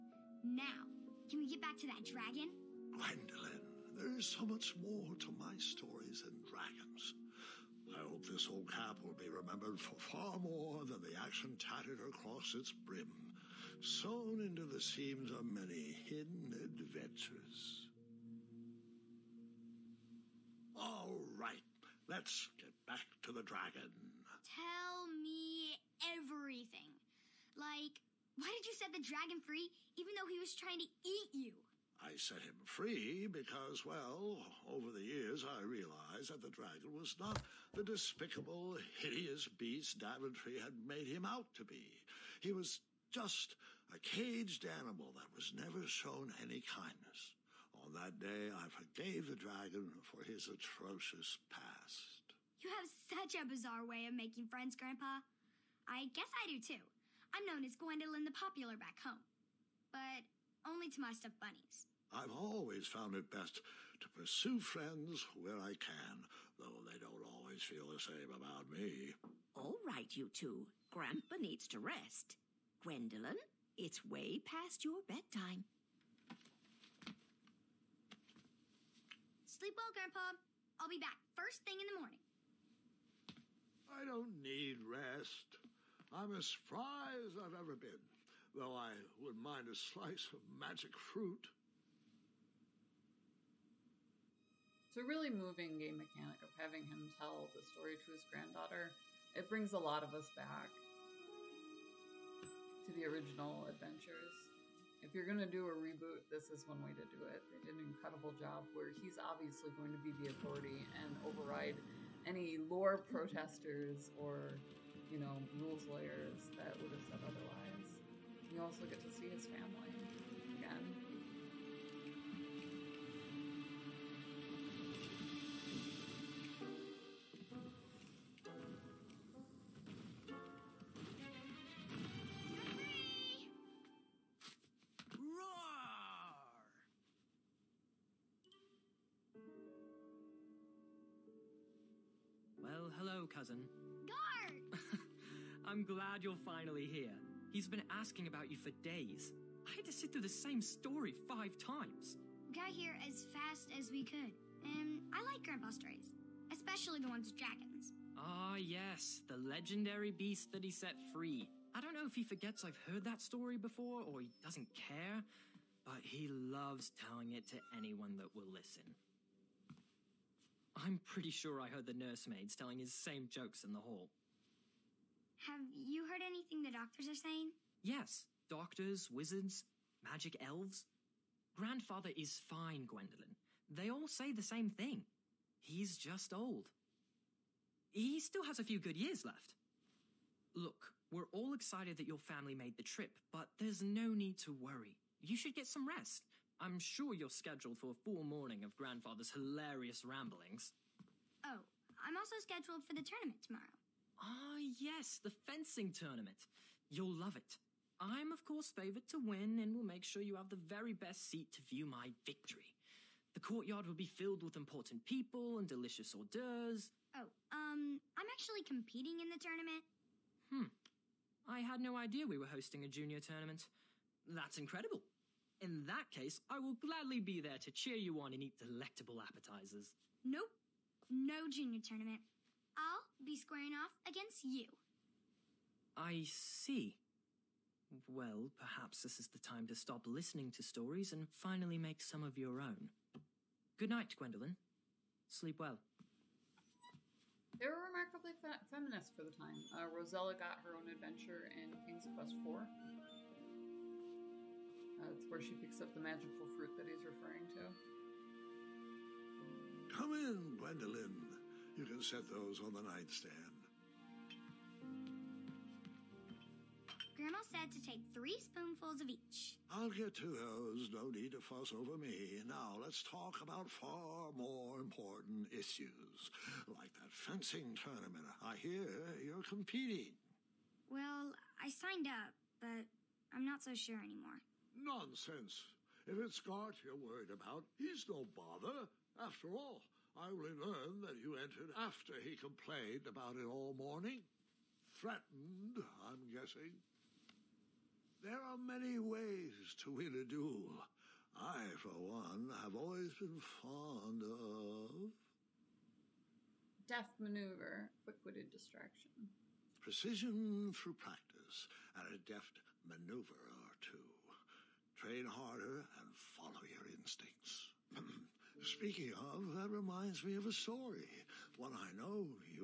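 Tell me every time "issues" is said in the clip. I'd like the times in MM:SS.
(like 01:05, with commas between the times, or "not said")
04:35.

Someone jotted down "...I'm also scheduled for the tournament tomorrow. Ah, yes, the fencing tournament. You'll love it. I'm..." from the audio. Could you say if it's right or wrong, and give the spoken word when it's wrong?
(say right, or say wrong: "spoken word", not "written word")
right.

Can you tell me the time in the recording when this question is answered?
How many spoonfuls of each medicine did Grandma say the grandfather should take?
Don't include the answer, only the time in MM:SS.
04:28.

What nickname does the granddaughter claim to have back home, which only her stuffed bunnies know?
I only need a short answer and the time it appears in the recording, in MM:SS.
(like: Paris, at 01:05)
Gwendolyn the Popular, at 00:57.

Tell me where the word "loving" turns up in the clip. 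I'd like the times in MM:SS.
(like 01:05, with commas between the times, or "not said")
not said.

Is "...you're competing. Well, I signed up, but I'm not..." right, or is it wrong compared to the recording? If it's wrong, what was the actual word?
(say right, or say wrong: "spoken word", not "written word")
right.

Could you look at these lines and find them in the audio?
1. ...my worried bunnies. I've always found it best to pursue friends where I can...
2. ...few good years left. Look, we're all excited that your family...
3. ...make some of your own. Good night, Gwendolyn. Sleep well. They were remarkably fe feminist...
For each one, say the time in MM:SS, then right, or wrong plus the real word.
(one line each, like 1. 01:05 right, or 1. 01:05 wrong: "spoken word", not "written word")
1. 01:01 wrong: "stuffed", not "worried"
2. 03:08 right
3. 04:01 right.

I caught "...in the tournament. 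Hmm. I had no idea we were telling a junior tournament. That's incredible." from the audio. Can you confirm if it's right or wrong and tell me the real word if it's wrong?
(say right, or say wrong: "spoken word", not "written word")
wrong: "hosting", not "telling".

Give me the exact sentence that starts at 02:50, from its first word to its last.
I'm pretty sure I heard the nursemaids telling his same jokes in the hall.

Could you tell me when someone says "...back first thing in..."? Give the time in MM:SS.
01:20.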